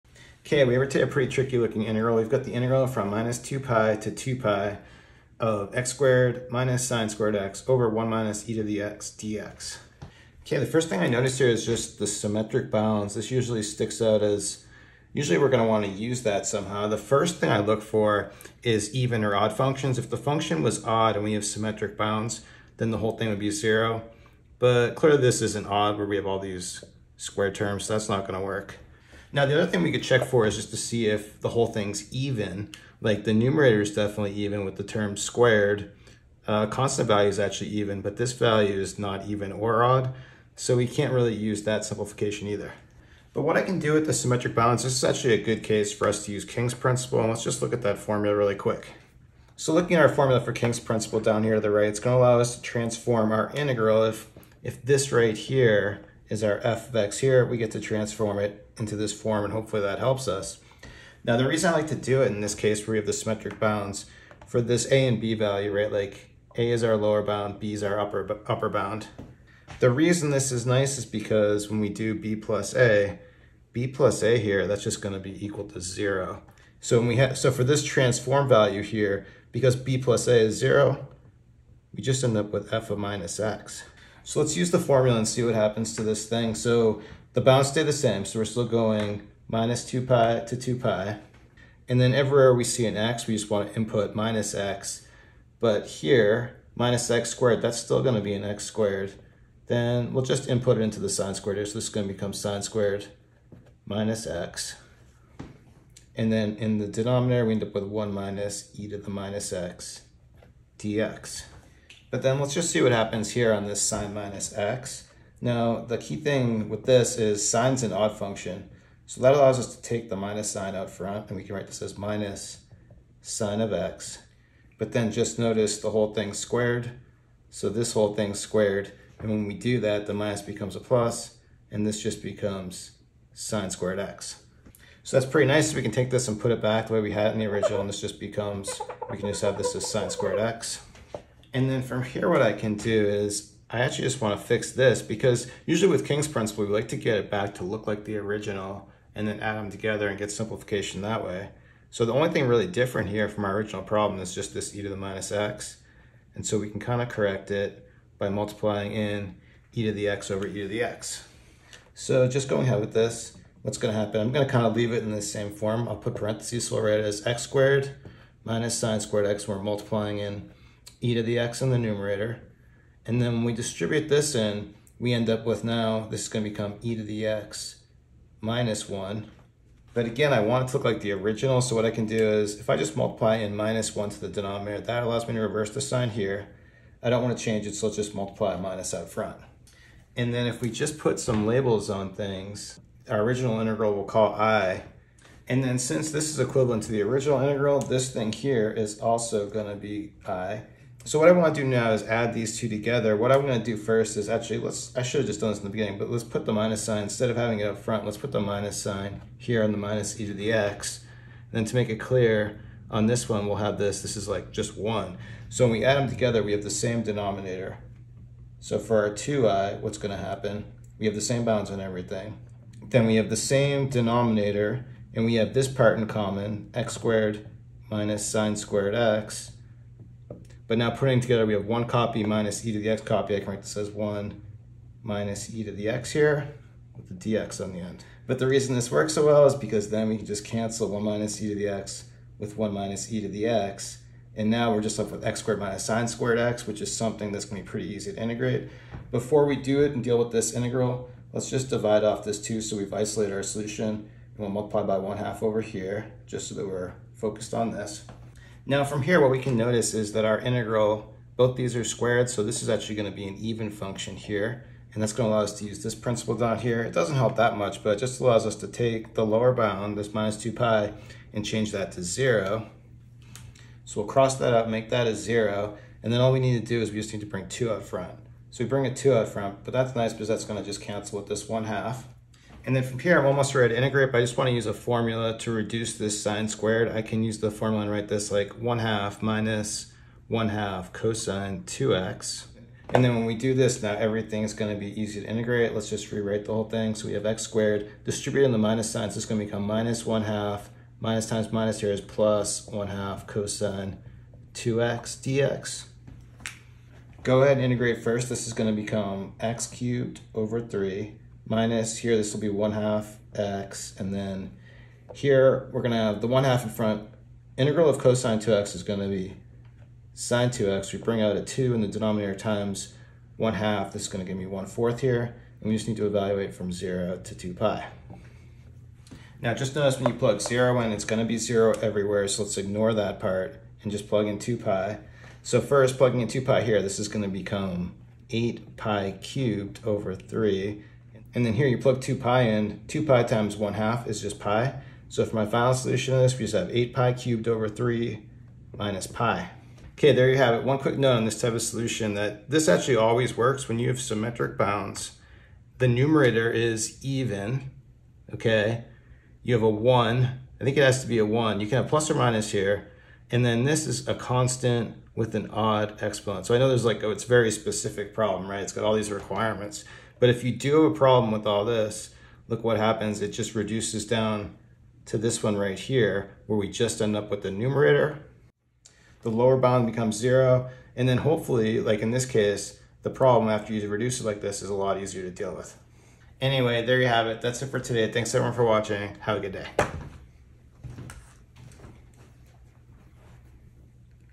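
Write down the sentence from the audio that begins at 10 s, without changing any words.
Okay, the first thing I notice here is just the symmetric bounds.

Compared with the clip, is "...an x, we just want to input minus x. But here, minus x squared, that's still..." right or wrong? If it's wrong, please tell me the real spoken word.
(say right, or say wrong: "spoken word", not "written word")
right.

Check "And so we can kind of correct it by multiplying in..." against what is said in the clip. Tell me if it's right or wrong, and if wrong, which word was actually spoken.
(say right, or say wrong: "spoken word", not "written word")
right.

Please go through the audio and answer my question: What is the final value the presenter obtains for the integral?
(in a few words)
8π³/3 − π.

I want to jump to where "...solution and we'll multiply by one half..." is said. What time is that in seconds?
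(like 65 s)
253 s.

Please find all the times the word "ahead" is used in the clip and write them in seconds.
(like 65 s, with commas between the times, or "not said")
162 s, 307 s.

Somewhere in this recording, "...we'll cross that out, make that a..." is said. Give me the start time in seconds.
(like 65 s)
274 s.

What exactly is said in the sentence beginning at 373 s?
It just reduces down to this one right here, where we just end up with the numerator.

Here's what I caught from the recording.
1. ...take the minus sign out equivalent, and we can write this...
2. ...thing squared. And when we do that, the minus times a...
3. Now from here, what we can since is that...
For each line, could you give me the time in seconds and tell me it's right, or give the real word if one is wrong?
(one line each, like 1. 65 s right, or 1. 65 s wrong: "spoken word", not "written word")
1. 119 s wrong: "front", not "equivalent"
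2. 128 s wrong: "becomes", not "times"
3. 258 s wrong: "notice", not "since".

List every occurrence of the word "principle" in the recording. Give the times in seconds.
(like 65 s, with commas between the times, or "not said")
46 s, 50 s, 146 s, 265 s.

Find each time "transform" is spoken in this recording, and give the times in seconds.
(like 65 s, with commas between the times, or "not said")
52 s, 57 s, 77 s.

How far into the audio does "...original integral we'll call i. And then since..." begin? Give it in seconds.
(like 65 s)
193 s.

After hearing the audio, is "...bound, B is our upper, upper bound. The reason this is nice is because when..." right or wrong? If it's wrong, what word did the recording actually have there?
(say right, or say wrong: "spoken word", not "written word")
right.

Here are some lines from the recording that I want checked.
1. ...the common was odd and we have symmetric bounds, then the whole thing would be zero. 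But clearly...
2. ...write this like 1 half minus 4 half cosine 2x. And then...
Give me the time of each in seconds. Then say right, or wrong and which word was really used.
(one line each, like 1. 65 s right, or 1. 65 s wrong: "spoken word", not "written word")
1. 20 s wrong: "function", not "common"
2. 287 s wrong: "1", not "4".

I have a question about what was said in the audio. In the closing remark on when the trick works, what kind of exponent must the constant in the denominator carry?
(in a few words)
odd exponent.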